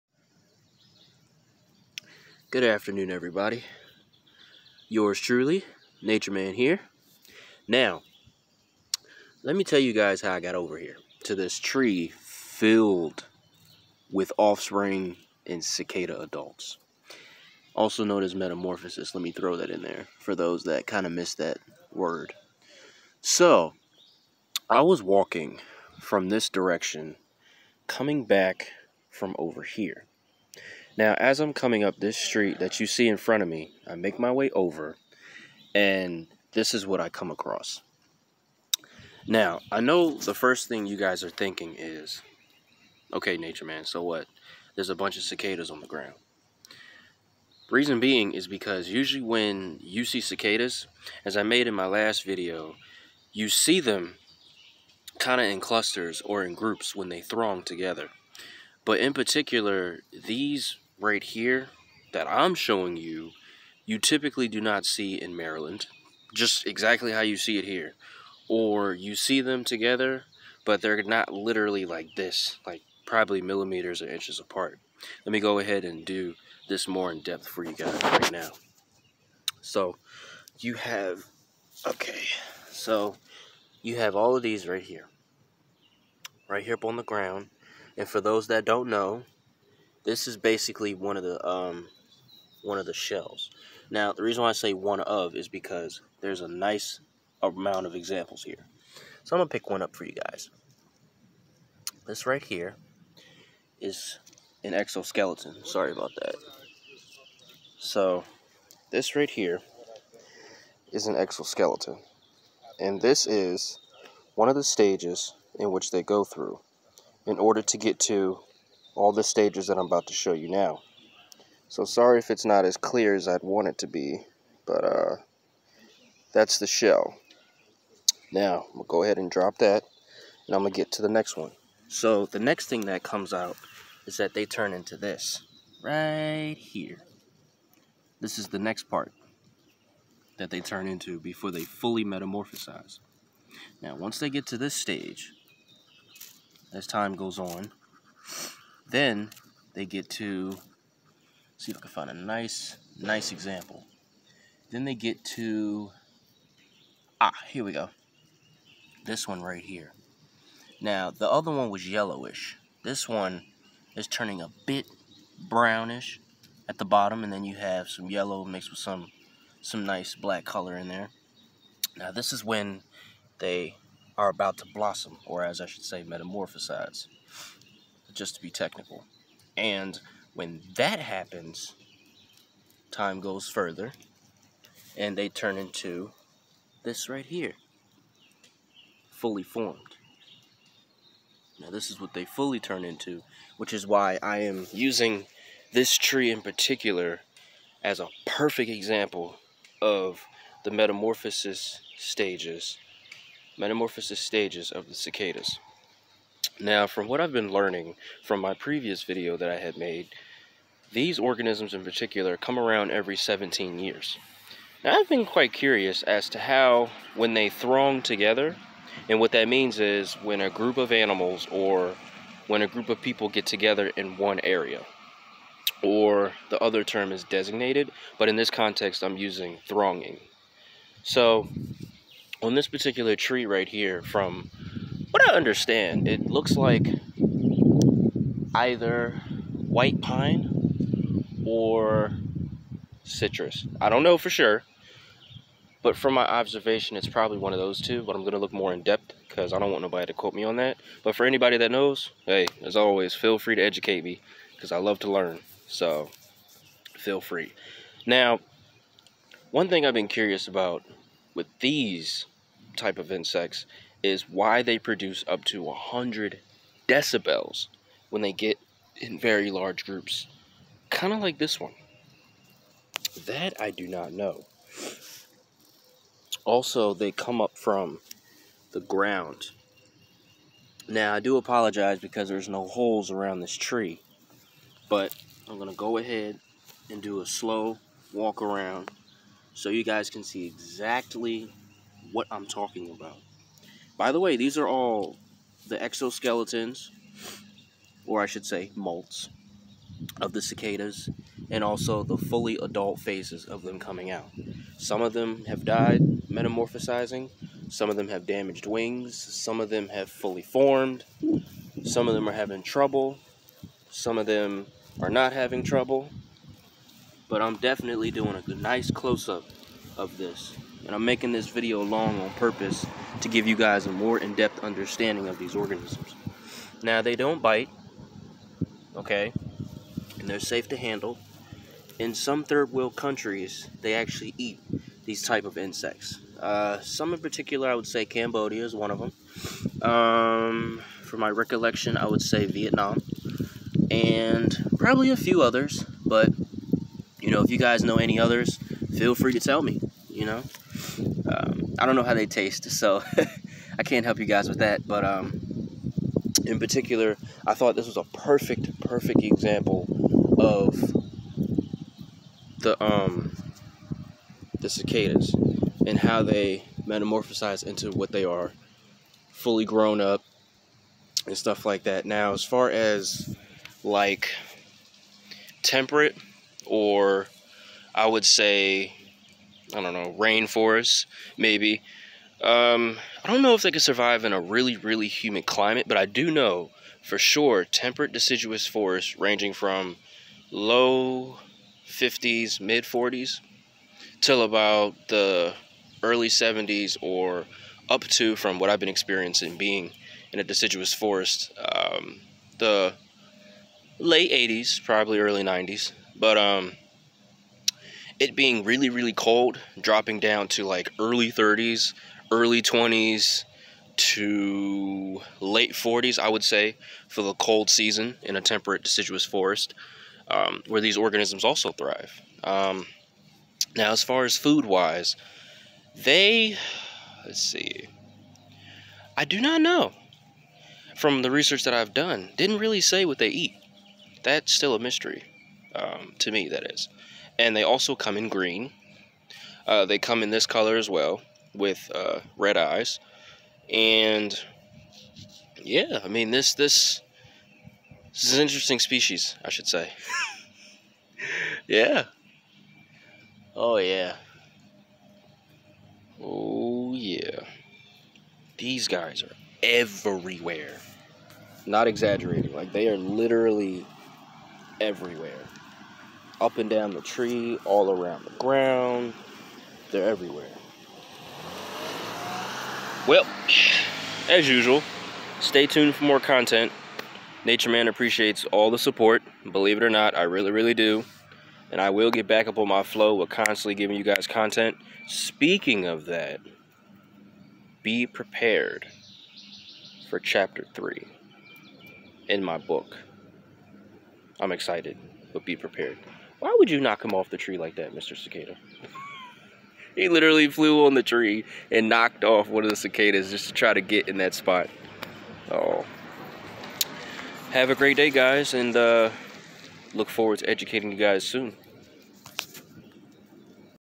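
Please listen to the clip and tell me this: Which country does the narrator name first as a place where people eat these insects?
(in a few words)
Cambodia.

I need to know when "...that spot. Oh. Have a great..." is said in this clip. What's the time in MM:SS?
08:24.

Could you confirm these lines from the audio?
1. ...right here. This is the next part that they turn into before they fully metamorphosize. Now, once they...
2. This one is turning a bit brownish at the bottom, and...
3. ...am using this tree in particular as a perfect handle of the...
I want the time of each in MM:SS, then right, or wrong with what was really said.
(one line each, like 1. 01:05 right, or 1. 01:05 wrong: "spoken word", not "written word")
1. 02:15 right
2. 02:42 right
3. 03:14 wrong: "example", not "handle".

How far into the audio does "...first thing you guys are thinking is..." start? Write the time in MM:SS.
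00:40.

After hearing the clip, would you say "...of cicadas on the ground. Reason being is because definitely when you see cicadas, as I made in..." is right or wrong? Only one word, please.
wrong.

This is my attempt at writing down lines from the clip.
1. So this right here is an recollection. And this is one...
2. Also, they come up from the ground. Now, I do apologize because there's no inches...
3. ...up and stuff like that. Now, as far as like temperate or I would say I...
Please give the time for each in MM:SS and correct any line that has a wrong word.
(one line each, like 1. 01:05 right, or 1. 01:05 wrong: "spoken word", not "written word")
1. 01:47 wrong: "exoskeleton", not "recollection"
2. 04:36 wrong: "holes", not "inches"
3. 06:10 right.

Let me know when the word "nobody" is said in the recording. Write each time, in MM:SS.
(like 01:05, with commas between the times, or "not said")
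04:09.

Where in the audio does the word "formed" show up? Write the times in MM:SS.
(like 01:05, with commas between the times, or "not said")
03:09, 05:10.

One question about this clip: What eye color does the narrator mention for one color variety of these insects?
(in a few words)
red.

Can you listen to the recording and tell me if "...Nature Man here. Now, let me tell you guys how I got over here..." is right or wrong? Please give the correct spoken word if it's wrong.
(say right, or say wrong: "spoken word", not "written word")
right.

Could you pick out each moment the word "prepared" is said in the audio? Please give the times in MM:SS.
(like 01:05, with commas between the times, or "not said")
08:08, 08:15.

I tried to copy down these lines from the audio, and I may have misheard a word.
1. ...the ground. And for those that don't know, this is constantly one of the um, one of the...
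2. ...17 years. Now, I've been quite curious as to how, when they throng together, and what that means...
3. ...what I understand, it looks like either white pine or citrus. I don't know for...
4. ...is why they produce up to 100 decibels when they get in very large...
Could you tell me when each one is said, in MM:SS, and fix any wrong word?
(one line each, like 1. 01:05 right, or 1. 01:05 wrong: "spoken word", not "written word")
1. 01:26 wrong: "basically", not "constantly"
2. 03:33 right
3. 03:55 right
4. 04:24 right.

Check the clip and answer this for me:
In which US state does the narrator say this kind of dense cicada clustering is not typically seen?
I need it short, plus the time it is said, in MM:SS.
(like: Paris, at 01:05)
Maryland, at 01:05.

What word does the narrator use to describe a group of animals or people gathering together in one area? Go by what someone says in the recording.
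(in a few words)
thronging.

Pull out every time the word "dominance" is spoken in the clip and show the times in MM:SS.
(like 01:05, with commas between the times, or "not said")
not said.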